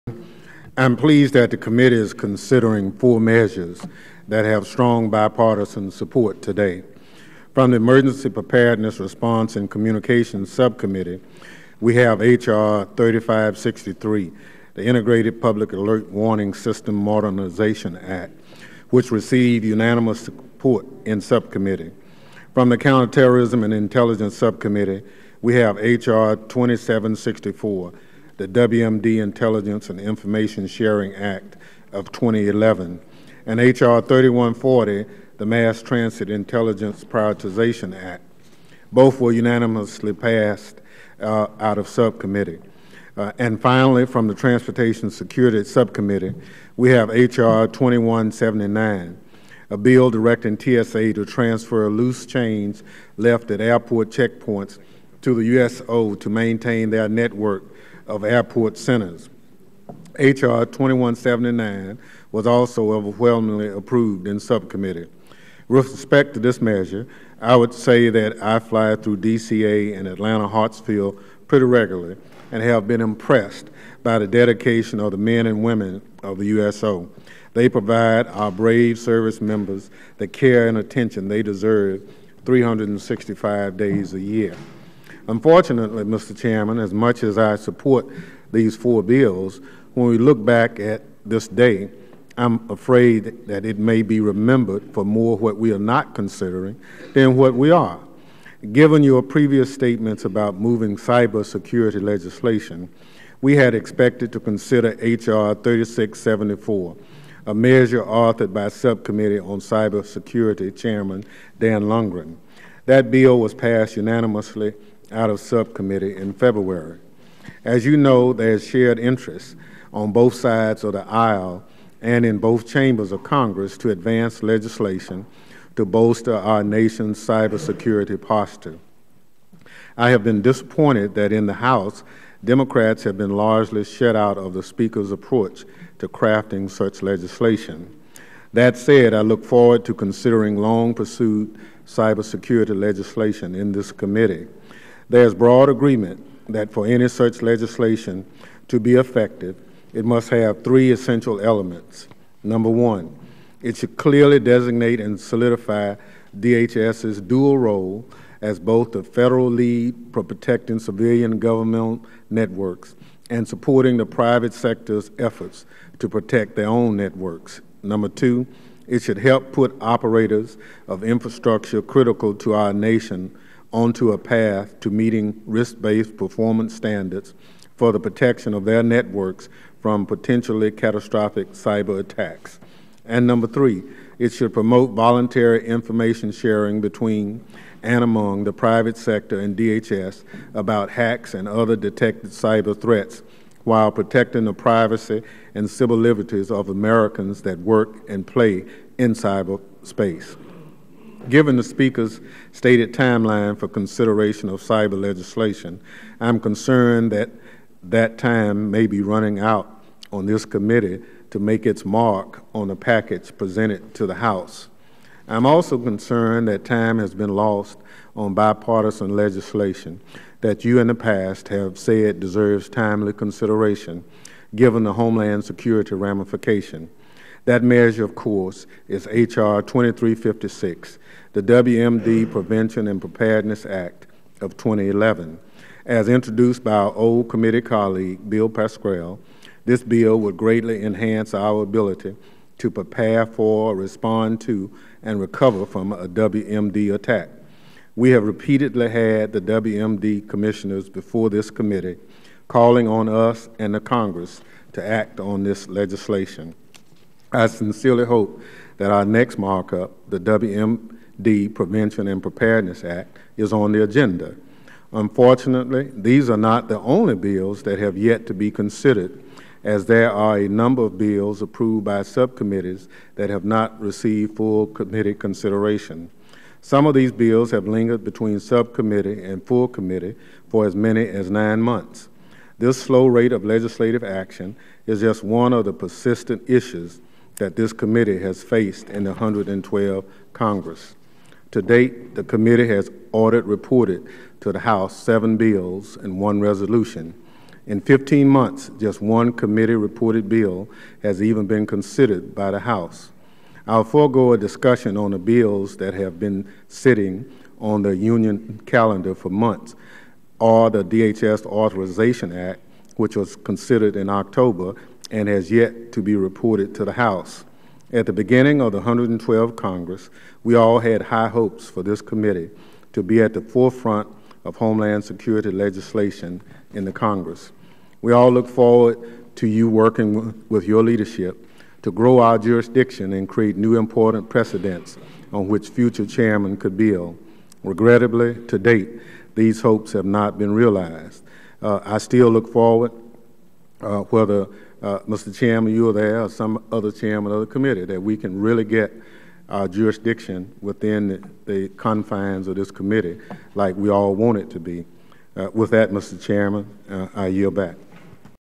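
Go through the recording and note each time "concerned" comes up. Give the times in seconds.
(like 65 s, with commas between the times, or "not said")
206 s, 215 s.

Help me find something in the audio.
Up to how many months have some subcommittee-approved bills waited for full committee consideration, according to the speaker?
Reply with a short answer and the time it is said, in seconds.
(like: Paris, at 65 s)
9, at 281 s.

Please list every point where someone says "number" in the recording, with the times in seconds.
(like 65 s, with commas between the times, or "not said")
152 s, 167 s, 183 s, 270 s.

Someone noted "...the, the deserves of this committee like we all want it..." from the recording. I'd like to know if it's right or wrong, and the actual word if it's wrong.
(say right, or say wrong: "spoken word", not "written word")
wrong: "confines", not "deserves".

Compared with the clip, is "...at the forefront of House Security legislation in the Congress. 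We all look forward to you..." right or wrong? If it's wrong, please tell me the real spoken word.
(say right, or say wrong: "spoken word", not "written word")
wrong: "Homeland", not "House".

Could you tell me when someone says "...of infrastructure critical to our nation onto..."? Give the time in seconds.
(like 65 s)
170 s.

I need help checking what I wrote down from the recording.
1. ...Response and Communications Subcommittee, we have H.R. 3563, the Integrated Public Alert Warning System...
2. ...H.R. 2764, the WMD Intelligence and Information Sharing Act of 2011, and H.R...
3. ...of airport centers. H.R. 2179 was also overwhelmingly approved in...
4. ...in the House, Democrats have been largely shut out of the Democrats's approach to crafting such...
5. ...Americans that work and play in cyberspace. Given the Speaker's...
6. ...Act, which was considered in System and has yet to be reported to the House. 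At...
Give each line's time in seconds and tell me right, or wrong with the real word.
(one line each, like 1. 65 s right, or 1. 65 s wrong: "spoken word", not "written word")
1. 8 s right
2. 25 s right
3. 58 s right
4. 131 s wrong: "Speaker", not "Democrats"
5. 196 s right
6. 312 s wrong: "October", not "System".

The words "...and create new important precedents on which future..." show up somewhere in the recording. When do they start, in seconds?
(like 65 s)
333 s.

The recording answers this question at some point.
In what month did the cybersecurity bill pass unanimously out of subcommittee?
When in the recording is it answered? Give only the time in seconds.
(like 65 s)
116 s.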